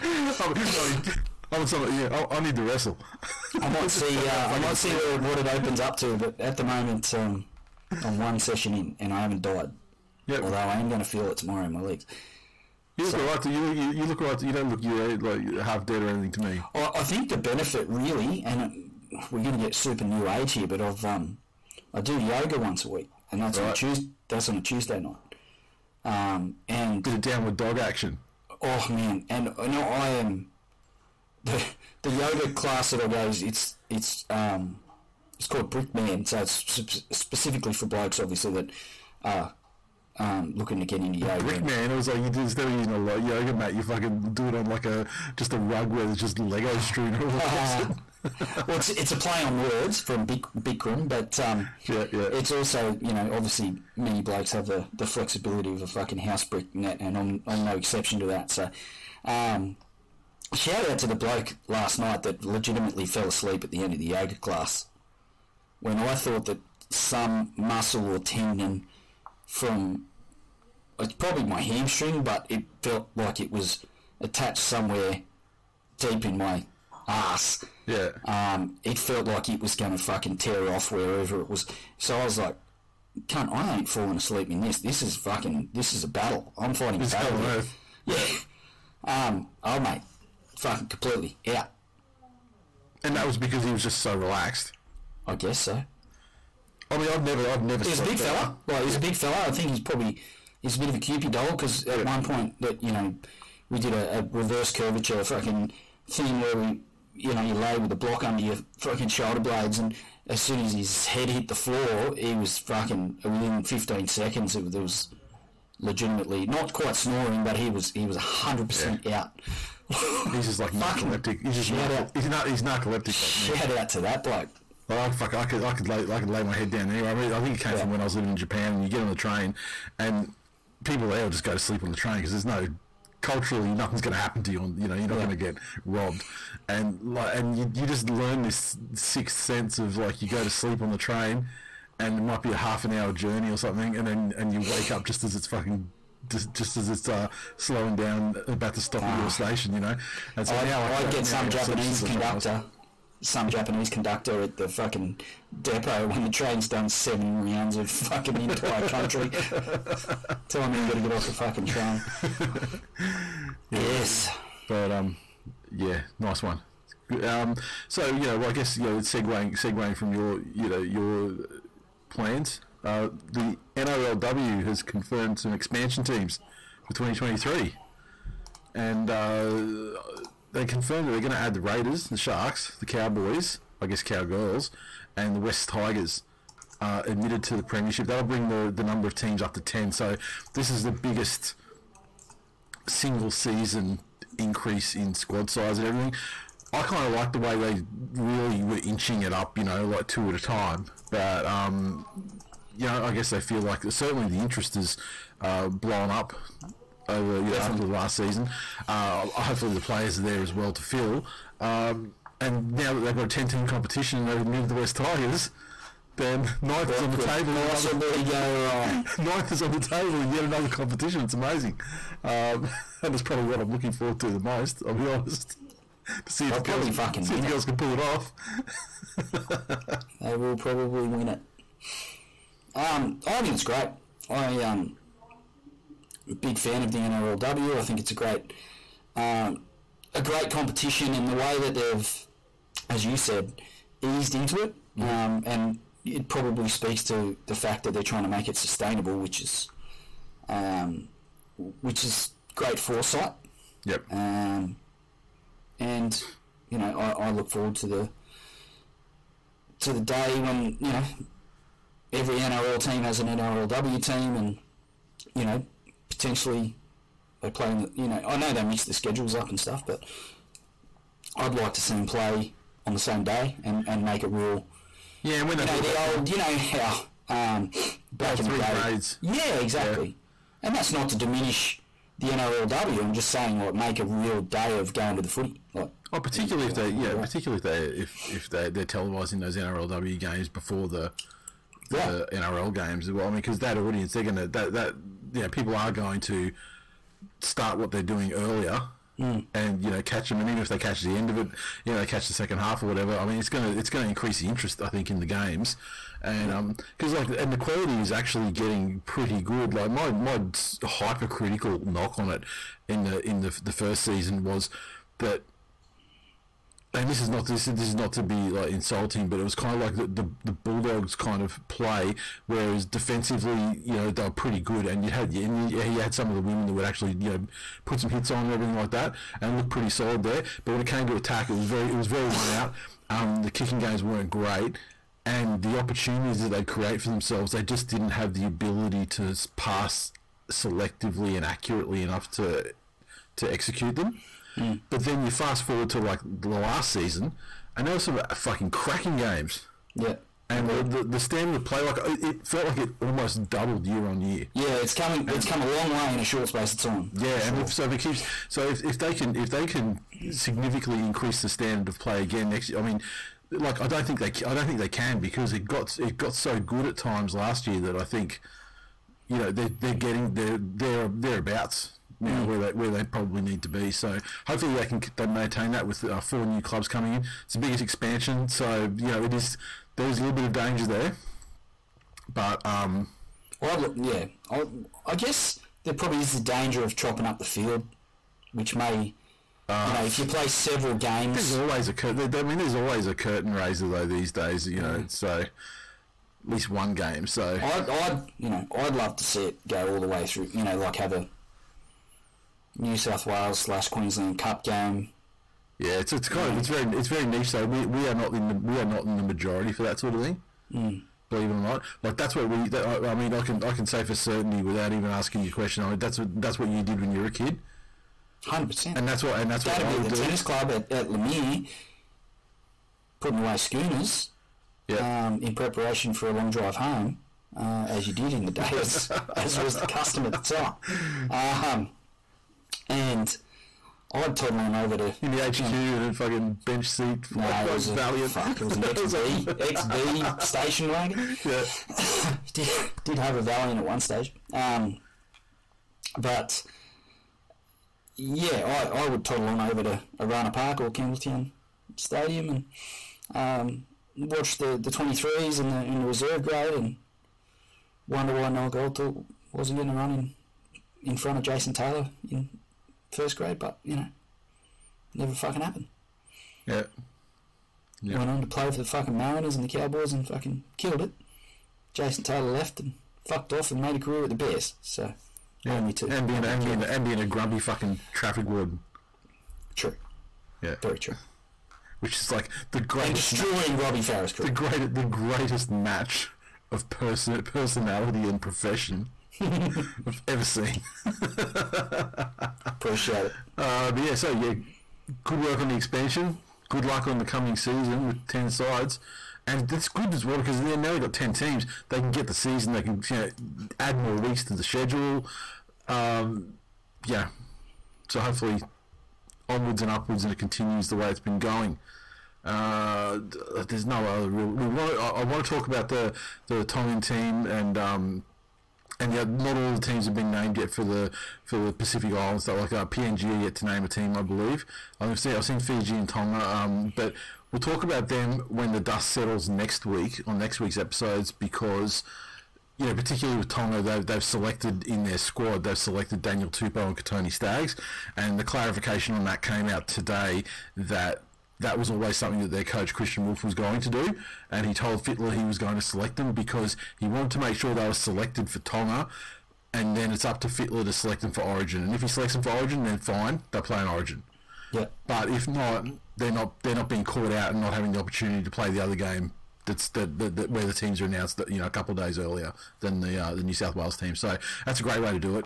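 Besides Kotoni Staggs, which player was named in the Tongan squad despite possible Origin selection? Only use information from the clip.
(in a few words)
Daniel Tupou.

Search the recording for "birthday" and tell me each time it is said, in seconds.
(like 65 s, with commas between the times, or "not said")
not said.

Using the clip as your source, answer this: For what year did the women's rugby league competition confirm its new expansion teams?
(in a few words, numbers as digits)
2023.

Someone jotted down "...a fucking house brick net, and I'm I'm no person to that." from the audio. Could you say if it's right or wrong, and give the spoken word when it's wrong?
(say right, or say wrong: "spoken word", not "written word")
wrong: "exception", not "person".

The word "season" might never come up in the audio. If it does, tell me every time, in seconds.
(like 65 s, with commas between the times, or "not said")
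193 s, 208 s, 314 s, 346 s, 497 s, 502 s.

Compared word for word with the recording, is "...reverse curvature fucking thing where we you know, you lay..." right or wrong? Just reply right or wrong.
right.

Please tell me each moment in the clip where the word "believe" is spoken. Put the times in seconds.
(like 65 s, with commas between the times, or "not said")
411 s, 524 s.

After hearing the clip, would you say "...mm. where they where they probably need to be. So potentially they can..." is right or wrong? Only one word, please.
wrong.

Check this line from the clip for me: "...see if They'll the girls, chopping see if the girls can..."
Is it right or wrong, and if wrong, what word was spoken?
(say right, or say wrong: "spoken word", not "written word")
wrong: "fucking", not "chopping".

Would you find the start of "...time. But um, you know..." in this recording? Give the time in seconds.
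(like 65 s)
200 s.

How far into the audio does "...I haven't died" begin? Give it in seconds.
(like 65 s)
9 s.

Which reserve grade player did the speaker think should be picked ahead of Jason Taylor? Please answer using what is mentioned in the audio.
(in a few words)
Noel Goldthorpe.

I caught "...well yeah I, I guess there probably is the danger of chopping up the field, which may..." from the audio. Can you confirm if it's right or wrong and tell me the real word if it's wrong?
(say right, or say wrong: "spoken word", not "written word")
right.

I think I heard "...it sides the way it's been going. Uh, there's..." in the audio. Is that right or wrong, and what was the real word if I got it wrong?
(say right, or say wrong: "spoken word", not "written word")
wrong: "continues", not "sides".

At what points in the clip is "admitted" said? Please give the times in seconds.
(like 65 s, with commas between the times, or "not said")
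187 s, 214 s.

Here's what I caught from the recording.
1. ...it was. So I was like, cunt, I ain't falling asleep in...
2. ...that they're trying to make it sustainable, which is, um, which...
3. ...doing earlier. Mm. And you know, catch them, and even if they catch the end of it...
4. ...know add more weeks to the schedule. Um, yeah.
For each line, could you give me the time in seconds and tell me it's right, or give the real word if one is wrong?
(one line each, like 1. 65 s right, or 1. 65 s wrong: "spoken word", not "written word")
1. 81 s right
2. 247 s right
3. 298 s right
4. 503 s right.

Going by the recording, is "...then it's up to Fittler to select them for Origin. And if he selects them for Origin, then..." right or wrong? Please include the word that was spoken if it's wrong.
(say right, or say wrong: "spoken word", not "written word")
right.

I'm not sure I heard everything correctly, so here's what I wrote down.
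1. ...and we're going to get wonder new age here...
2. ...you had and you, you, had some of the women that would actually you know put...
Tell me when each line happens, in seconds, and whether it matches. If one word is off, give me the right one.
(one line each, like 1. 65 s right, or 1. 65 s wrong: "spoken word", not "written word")
1. 18 s wrong: "super", not "wonder"
2. 325 s right.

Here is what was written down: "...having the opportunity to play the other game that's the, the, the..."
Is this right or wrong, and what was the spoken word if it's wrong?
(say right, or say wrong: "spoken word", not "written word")
right.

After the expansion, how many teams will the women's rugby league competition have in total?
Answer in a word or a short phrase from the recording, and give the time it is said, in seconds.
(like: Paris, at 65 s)
10, at 189 s.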